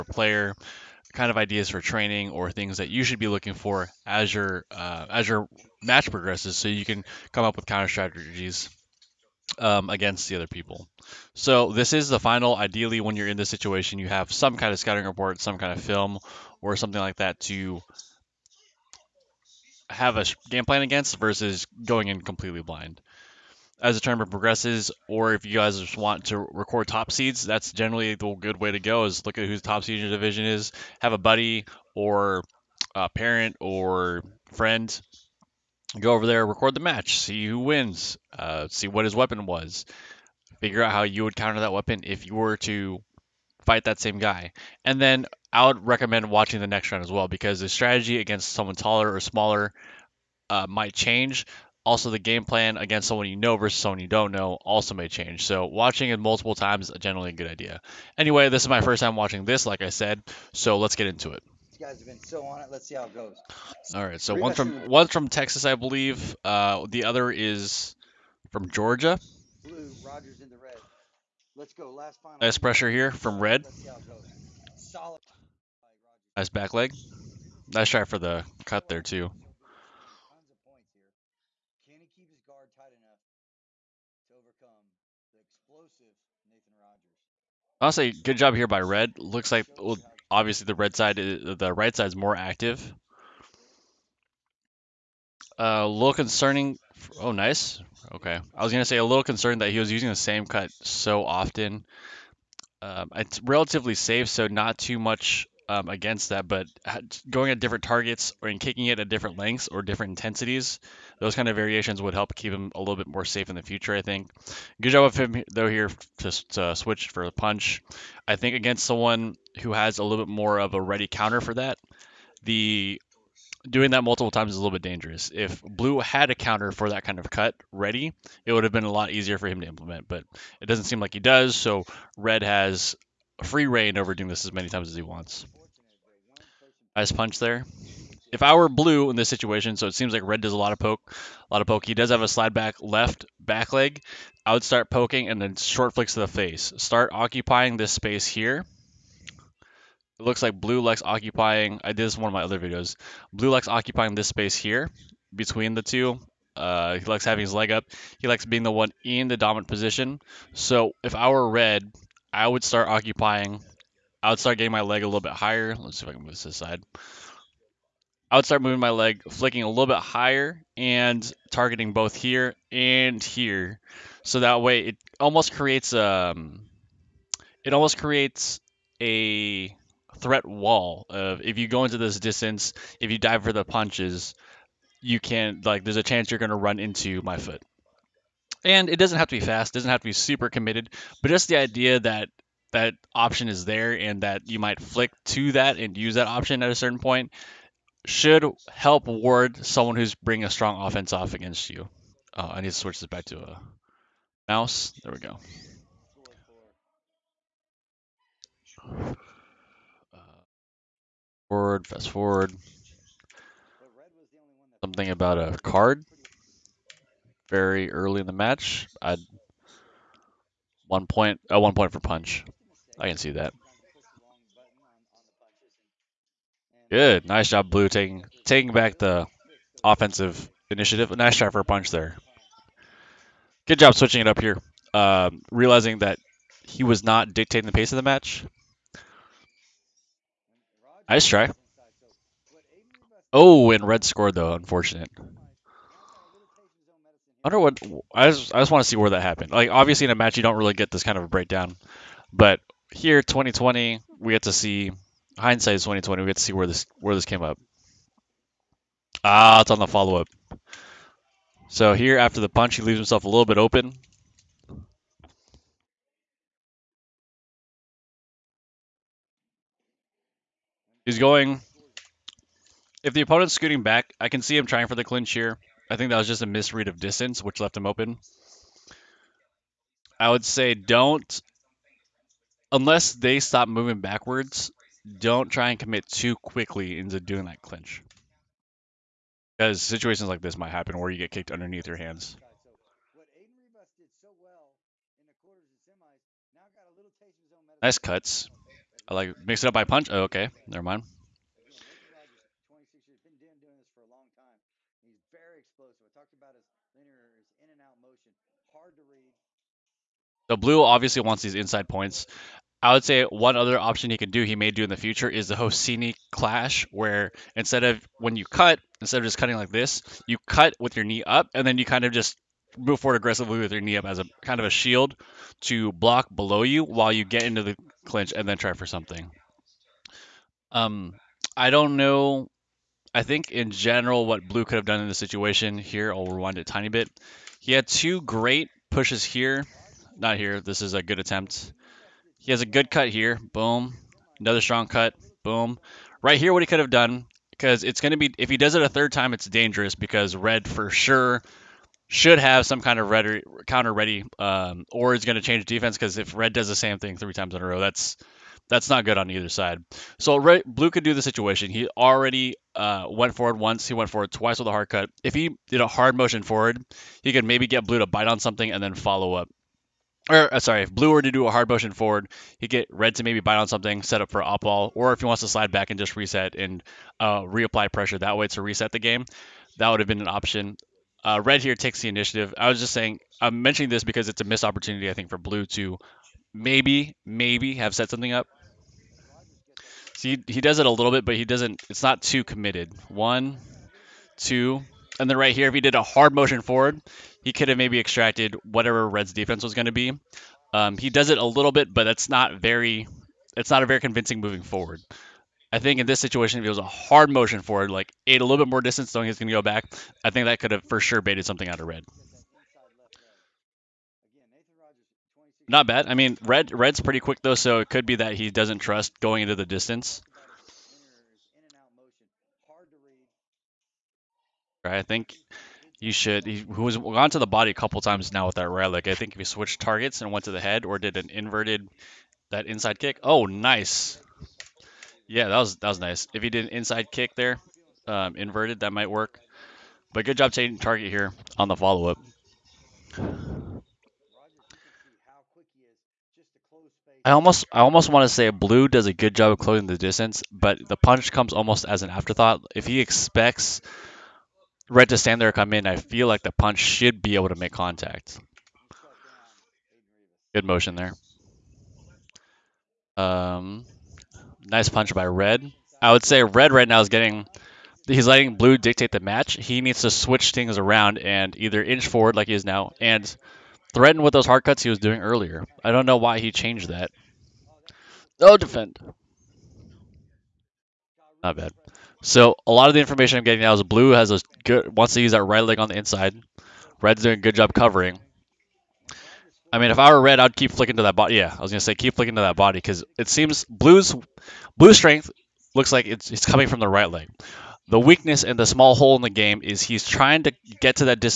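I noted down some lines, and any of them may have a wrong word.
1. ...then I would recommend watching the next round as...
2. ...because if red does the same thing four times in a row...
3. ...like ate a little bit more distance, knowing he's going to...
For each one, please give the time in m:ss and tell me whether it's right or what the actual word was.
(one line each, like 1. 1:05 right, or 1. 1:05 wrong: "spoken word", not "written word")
1. 0:45 right
2. 5:55 wrong: "three", not "four"
3. 6:47 right.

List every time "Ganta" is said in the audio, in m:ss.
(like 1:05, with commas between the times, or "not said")
not said.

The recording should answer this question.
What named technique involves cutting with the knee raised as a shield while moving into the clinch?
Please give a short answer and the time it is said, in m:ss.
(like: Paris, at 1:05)
Hosini clash, at 5:15.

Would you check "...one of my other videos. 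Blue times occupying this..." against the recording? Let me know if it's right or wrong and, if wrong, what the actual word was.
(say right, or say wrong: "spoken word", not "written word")
wrong: "likes", not "times".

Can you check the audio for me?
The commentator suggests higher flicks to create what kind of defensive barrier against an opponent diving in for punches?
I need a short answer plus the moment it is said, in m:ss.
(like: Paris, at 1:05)
Threat wall, at 3:00.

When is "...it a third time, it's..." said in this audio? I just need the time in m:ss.
5:48.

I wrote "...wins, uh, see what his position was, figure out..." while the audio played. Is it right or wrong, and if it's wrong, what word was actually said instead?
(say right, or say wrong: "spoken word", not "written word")
wrong: "weapon", not "position".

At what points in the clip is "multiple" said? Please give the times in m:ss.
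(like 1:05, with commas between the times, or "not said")
0:56, 2:04.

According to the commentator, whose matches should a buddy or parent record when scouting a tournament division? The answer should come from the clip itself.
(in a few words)
Top seeds.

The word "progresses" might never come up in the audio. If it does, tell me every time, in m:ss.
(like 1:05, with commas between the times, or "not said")
0:06, 0:24.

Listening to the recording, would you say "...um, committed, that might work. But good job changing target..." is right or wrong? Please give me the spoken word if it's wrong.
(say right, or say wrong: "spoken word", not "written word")
wrong: "inverted", not "committed".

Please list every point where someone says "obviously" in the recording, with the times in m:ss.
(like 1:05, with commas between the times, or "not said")
1:30, 4:09.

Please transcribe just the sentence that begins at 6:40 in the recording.
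Um, he does it a little bit, but that's not very.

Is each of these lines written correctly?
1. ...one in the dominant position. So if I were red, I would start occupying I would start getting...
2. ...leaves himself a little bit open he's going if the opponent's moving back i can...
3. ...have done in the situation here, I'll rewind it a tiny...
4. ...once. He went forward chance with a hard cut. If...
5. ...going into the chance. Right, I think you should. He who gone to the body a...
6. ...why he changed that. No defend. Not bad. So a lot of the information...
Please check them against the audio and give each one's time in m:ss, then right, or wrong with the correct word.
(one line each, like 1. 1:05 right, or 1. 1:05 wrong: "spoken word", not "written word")
1. 2:38 right
2. 4:22 wrong: "scooting", not "moving"
3. 5:34 right
4. 6:03 wrong: "twice", not "chance"
5. 6:59 wrong: "distance", not "chance"
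6. 7:56 right.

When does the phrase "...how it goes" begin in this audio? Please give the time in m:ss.
1:02.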